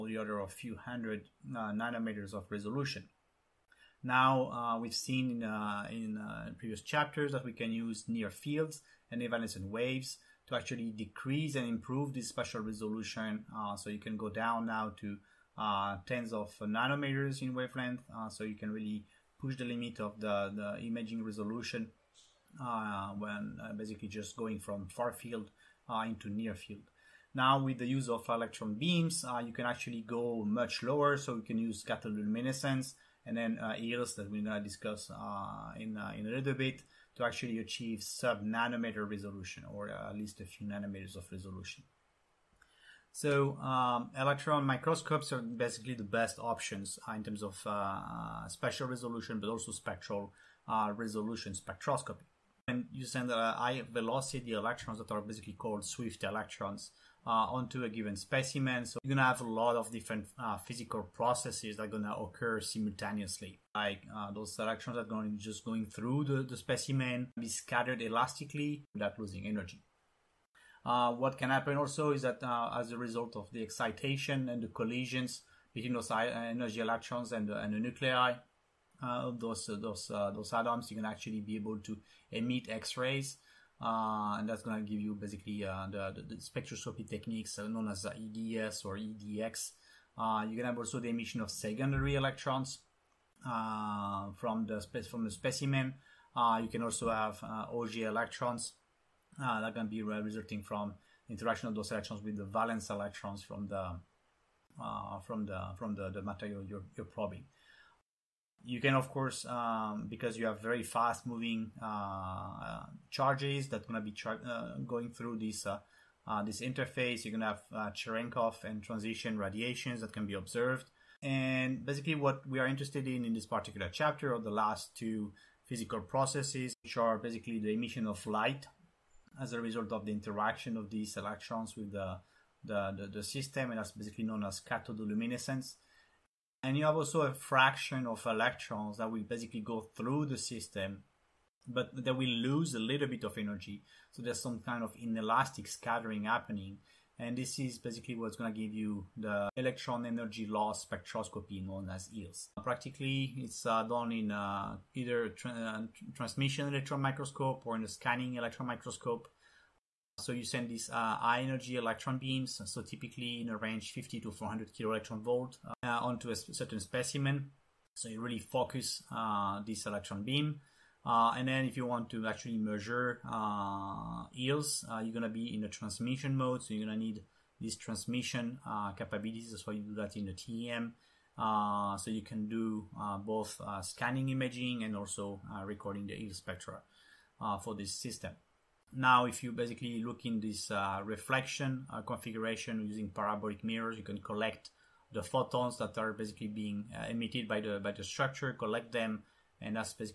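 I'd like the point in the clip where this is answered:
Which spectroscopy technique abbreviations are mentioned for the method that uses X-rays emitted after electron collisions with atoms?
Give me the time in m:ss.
1:28.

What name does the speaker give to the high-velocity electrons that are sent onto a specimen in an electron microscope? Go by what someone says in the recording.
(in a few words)
swift electrons.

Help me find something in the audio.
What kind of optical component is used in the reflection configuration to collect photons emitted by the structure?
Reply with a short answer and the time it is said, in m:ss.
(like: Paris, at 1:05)
parabolic mirrors, at 3:13.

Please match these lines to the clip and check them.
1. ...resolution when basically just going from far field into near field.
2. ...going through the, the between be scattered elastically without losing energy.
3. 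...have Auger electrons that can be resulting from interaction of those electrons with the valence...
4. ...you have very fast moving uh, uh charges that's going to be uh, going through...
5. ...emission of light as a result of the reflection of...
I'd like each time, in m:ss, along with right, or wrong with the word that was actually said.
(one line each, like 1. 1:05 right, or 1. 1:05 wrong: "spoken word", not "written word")
1. 0:21 right
2. 1:05 wrong: "specimen", not "between"
3. 1:37 right
4. 1:50 right
5. 2:07 wrong: "interaction", not "reflection".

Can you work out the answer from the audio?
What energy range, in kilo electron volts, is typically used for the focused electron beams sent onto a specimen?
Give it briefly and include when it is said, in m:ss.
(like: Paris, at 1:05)
50 to 400, at 2:43.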